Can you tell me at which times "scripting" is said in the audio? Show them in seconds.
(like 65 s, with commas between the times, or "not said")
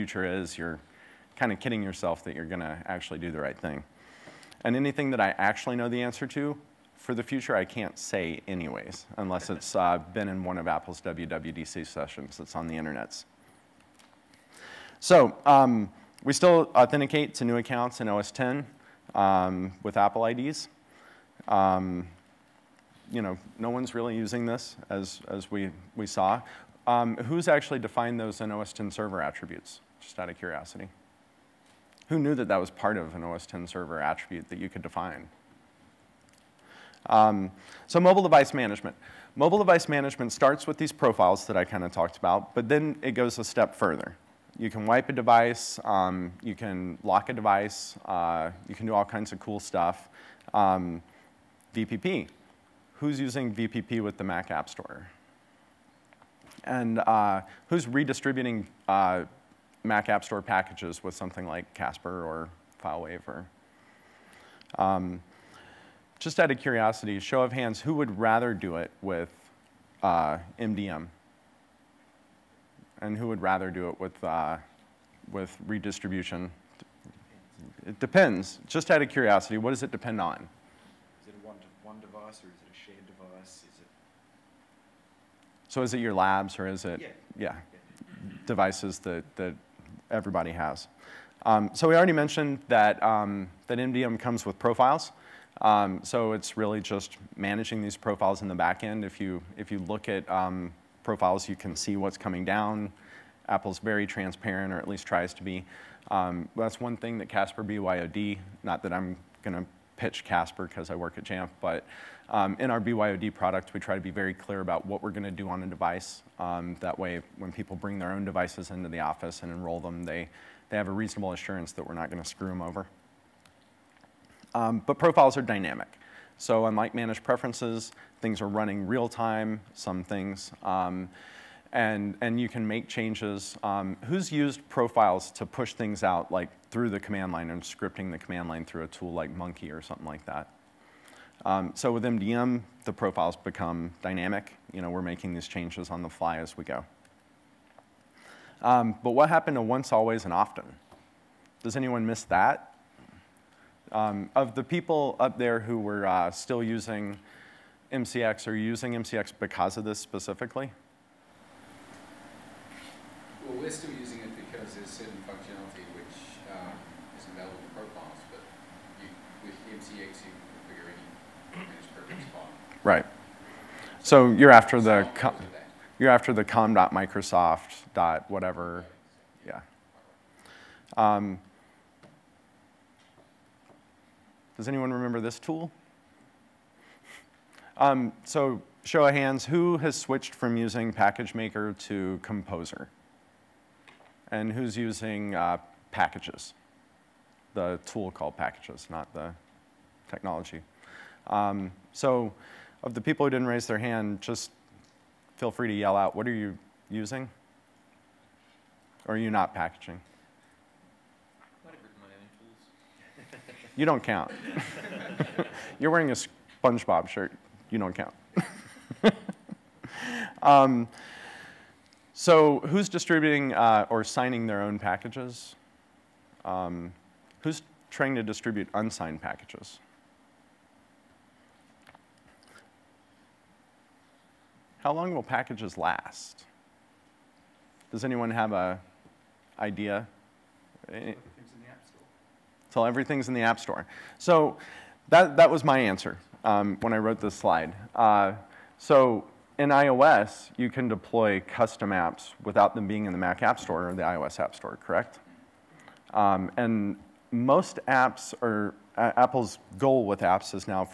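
137 s.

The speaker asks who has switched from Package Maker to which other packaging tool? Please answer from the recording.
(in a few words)
Composer.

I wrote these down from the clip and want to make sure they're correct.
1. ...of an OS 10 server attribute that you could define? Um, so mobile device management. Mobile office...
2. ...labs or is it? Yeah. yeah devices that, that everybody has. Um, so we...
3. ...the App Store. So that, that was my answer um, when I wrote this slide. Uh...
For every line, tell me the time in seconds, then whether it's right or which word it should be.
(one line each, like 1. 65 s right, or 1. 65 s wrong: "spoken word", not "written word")
1. 32 s wrong: "device", not "office"
2. 86 s right
3. 243 s right.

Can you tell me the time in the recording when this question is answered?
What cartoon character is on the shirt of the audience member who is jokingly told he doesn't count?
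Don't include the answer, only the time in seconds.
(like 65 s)
216 s.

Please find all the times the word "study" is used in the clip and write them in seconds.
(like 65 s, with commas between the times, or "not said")
not said.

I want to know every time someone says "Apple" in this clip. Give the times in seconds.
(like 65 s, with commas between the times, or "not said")
10 s, 19 s, 103 s, 259 s.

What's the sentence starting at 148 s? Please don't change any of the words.
Um, but what happened to once, always, and often?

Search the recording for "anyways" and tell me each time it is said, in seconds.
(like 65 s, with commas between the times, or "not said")
8 s.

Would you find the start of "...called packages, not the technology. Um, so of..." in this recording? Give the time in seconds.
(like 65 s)
198 s.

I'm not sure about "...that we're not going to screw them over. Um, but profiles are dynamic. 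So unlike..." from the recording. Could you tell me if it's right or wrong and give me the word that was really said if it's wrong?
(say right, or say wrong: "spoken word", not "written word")
right.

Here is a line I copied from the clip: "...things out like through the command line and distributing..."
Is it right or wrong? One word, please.
wrong.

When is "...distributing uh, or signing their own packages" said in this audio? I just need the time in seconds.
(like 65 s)
222 s.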